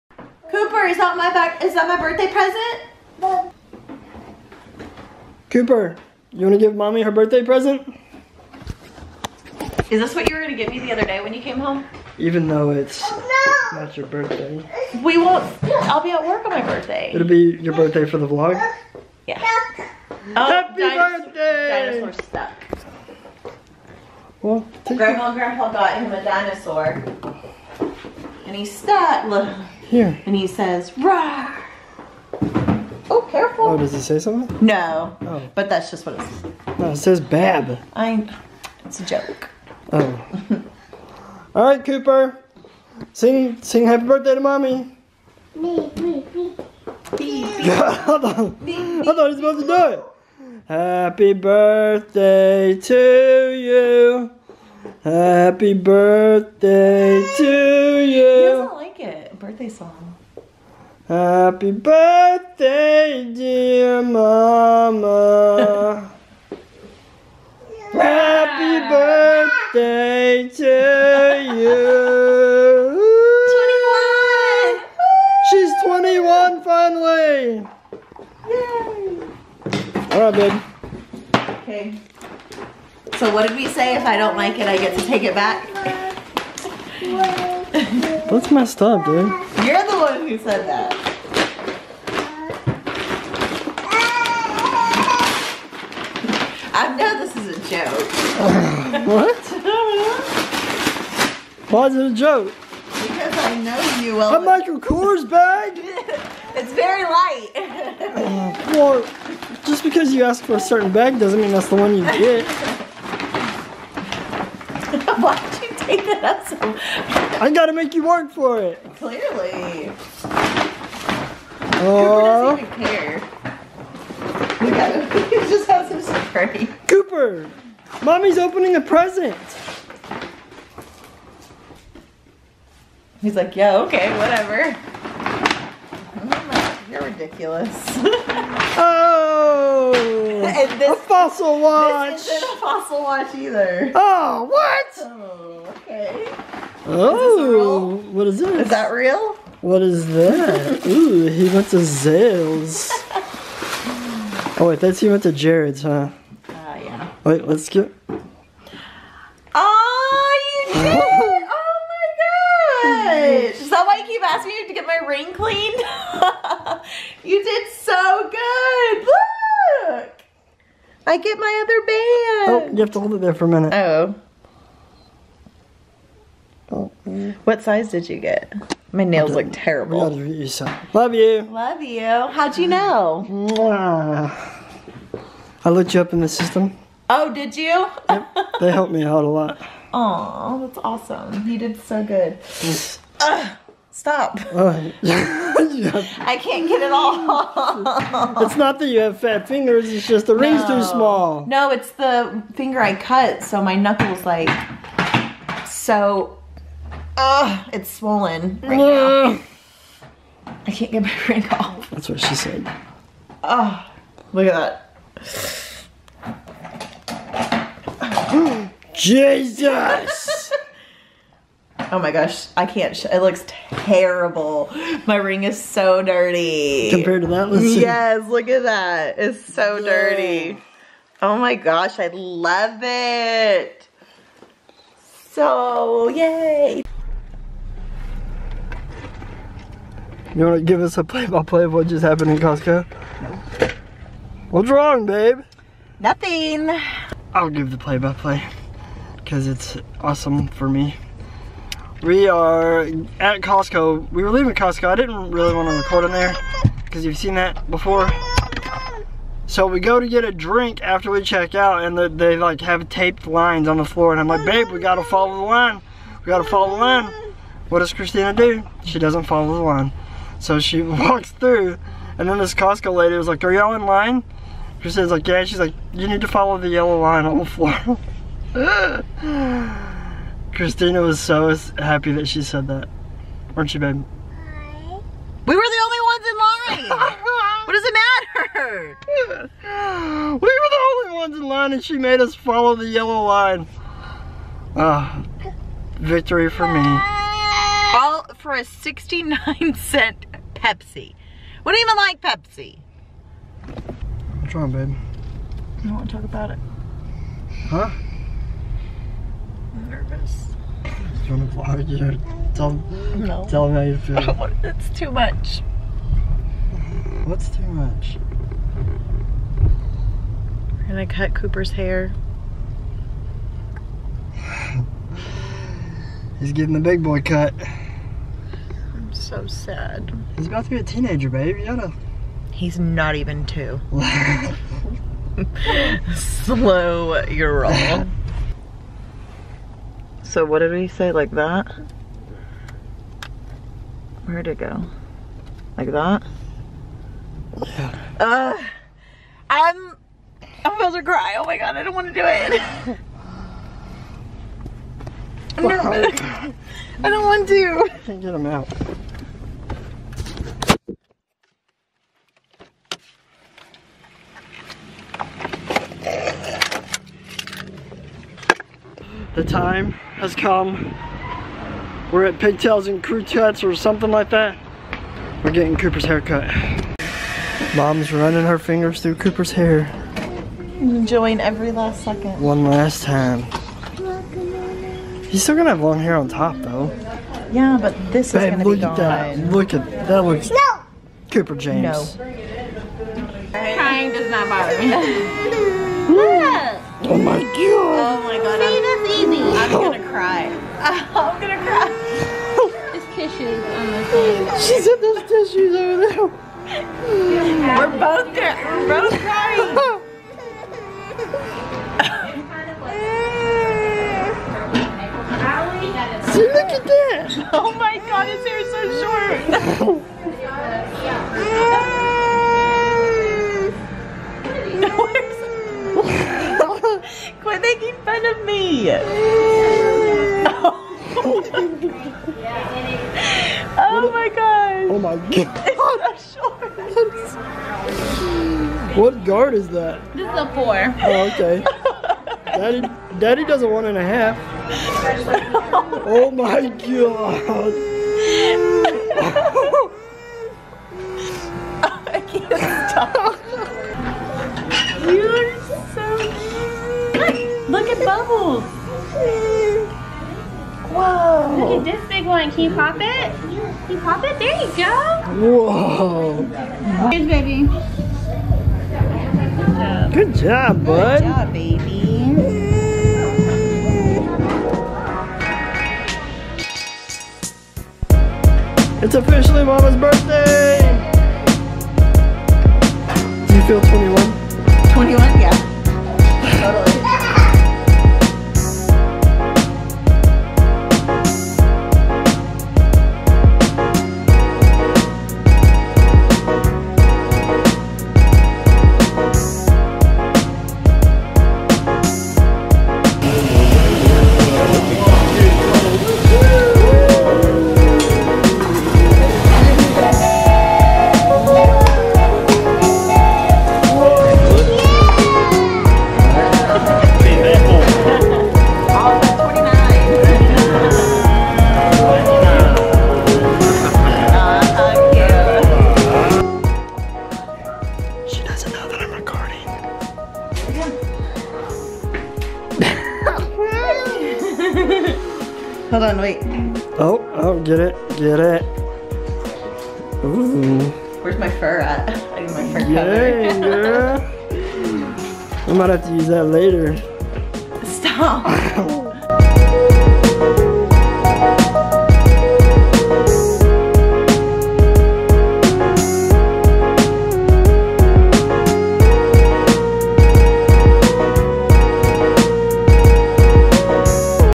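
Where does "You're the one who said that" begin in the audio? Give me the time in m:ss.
1:29.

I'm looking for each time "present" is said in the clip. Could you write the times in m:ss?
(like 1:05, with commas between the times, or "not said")
0:02, 0:07, 2:08.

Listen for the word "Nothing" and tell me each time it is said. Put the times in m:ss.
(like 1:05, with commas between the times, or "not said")
4:05.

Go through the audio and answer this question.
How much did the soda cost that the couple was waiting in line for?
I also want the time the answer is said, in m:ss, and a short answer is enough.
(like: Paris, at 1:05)
69 cents, at 4:58.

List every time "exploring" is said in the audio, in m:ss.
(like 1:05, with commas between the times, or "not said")
not said.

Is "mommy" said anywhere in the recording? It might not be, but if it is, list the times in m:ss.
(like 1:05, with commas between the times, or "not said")
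0:06, 0:44, 2:08.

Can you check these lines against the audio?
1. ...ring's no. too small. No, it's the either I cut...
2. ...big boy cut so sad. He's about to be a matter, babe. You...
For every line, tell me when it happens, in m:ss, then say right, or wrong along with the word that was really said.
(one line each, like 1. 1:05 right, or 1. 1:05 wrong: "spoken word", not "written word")
1. 3:20 wrong: "finger", not "either"
2. 5:26 wrong: "teenager", not "matter".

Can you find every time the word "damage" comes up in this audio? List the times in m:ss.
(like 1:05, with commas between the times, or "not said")
not said.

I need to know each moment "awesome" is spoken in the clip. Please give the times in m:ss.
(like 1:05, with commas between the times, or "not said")
3:10, 4:09.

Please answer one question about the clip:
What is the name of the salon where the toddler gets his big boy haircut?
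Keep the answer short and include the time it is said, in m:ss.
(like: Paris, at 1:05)
Pigtails and Crew Cuts, at 6:12.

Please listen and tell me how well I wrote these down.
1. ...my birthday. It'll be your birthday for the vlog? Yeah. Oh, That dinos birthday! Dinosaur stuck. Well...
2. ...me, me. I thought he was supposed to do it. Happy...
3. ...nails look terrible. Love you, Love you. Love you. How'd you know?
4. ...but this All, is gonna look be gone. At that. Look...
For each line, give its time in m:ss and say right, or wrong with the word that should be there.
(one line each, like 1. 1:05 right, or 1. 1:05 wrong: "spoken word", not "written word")
1. 0:16 wrong: "Happy", not "That"
2. 0:45 right
3. 2:59 right
4. 6:27 wrong: "Babe", not "All".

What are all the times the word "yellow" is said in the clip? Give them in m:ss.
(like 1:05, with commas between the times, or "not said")
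4:36, 4:52.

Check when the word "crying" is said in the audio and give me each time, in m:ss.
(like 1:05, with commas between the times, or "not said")
6:33, 6:49.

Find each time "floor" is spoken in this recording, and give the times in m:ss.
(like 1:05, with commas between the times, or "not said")
4:23, 4:37.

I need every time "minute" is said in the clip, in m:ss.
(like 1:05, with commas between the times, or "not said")
2:53.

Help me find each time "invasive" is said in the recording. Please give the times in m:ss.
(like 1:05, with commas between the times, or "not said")
not said.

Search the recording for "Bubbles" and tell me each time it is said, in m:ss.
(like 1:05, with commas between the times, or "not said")
7:38.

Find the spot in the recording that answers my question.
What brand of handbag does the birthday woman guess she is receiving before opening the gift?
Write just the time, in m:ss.
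1:44.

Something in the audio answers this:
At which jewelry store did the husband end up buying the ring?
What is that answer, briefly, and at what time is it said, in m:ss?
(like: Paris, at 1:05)
Jared's, at 2:35.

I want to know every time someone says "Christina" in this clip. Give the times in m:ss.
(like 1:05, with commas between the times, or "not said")
4:27, 4:40.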